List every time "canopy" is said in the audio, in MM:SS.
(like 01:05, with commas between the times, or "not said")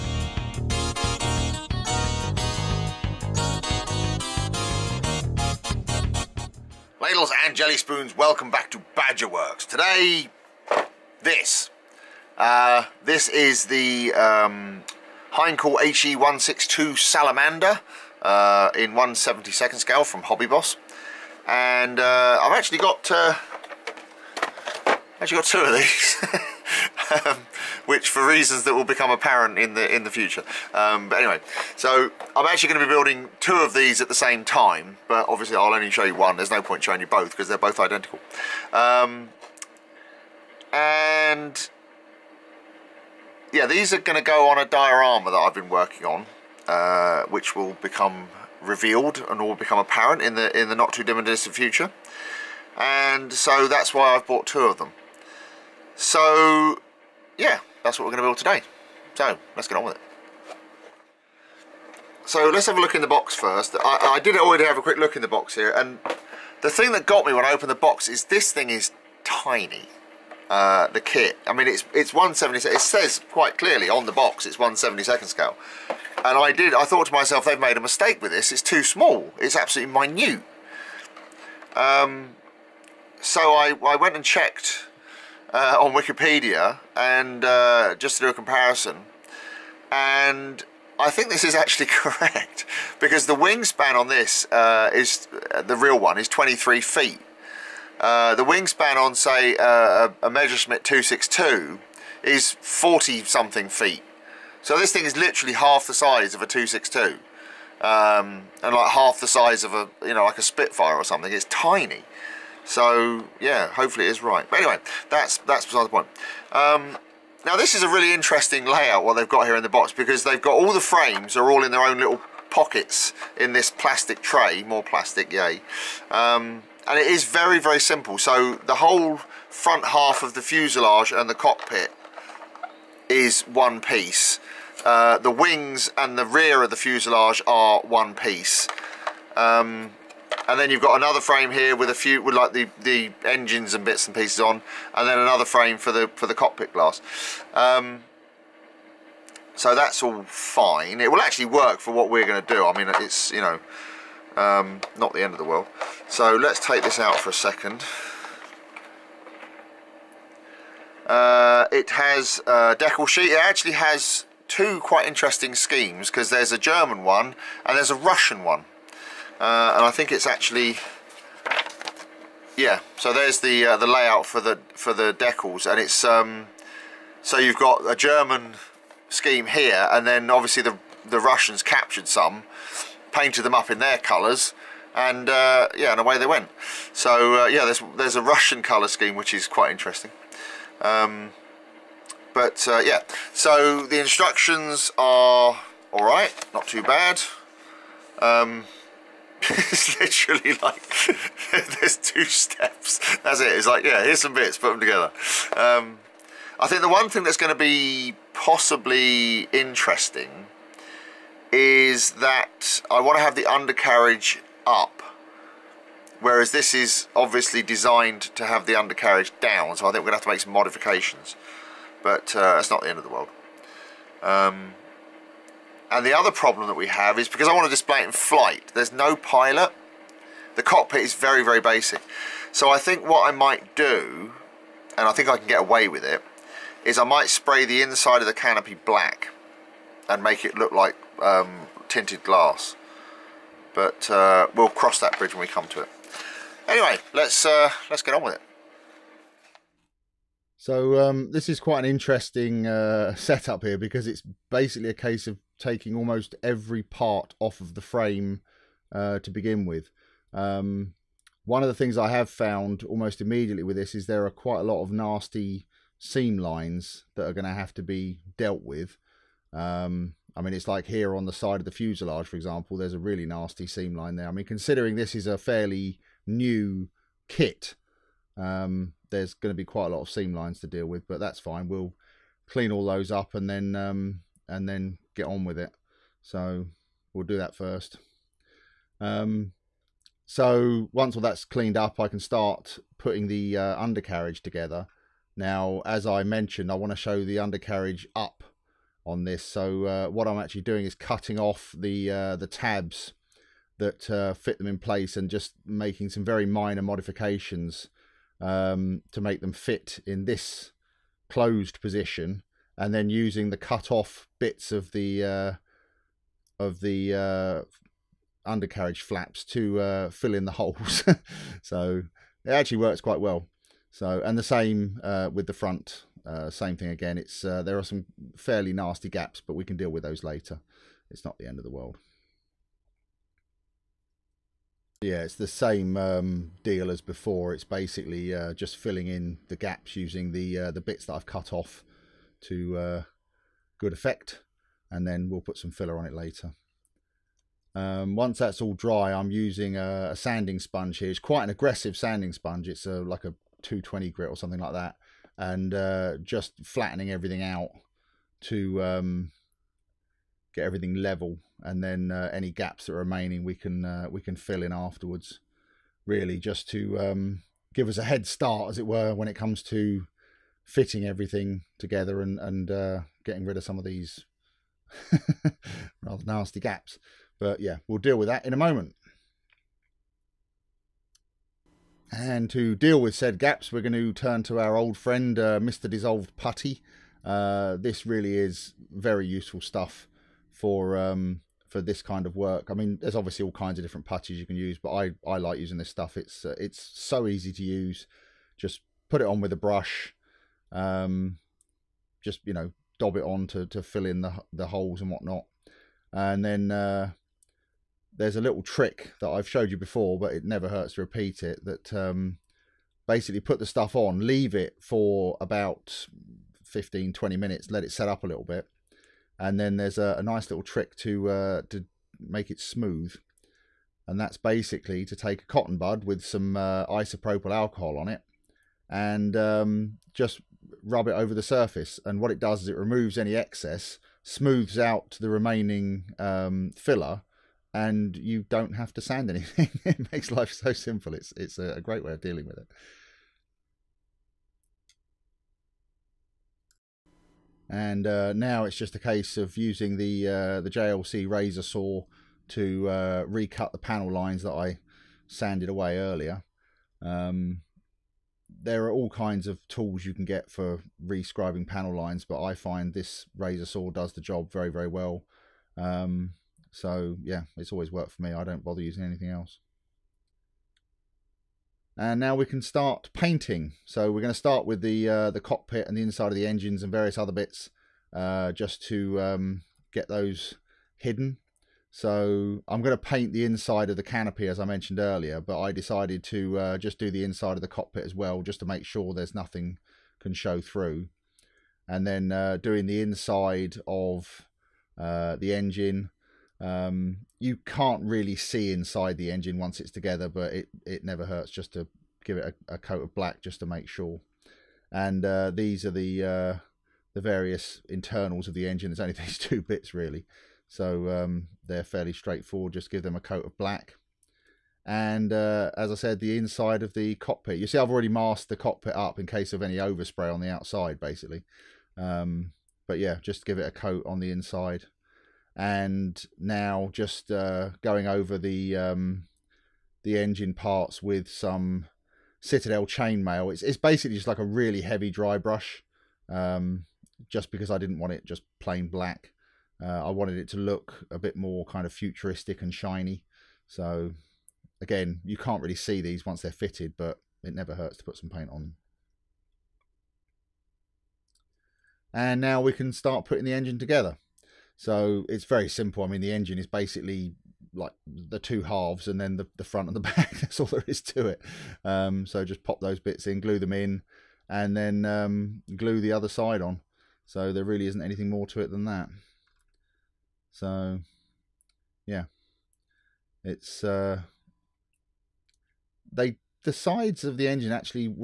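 03:58, 08:04.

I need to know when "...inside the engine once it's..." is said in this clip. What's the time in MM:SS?
08:18.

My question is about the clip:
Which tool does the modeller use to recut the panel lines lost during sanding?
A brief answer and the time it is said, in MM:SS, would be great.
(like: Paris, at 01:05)
JLC razor saw, at 07:30.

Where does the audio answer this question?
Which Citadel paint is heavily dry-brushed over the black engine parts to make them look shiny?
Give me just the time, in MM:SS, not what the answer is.
08:52.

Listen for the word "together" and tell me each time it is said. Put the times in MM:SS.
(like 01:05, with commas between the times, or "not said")
03:24, 04:54, 06:11, 08:19, 09:13.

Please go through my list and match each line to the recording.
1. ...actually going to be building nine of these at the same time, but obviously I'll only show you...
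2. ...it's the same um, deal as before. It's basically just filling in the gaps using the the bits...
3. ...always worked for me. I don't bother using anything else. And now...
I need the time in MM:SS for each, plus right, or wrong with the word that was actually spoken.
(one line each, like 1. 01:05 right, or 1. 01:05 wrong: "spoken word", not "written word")
1. 00:32 wrong: "two", not "nine"
2. 05:35 right
3. 07:47 right.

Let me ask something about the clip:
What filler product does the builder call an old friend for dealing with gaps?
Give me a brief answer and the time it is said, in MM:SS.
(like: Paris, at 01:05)
Mr. Dissolved Putty, at 06:25.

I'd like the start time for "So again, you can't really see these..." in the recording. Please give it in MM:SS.
09:03.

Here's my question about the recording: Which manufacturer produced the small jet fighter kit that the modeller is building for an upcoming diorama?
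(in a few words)
Hobby Boss.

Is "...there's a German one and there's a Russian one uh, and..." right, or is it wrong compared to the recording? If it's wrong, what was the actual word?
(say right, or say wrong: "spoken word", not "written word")
right.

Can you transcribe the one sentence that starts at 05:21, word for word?
so it actually works quite well.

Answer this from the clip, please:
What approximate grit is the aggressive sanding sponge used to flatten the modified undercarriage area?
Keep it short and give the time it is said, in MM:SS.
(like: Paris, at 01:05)
220, at 05:53.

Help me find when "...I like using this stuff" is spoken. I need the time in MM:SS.
06:35.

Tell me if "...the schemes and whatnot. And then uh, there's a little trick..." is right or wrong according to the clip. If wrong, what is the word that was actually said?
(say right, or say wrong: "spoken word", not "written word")
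wrong: "holes", not "schemes".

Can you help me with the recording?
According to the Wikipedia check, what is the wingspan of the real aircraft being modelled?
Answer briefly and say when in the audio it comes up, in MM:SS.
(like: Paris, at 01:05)
23 feet, at 01:36.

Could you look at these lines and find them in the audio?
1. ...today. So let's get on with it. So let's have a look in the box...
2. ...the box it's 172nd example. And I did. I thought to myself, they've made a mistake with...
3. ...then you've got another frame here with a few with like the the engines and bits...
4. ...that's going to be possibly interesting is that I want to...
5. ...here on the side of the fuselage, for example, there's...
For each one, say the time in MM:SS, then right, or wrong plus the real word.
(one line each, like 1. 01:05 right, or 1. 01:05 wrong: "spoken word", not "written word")
1. 00:58 right
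2. 01:14 wrong: "scale", not "example"
3. 02:20 right
4. 03:27 right
5. 04:30 right.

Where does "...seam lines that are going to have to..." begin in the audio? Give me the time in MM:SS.
04:25.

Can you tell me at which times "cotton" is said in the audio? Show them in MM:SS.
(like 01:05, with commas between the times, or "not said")
07:05.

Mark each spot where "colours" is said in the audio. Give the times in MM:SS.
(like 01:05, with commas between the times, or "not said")
03:03, 03:08.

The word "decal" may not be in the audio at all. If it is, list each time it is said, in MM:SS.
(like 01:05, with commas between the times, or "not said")
02:42, 02:55.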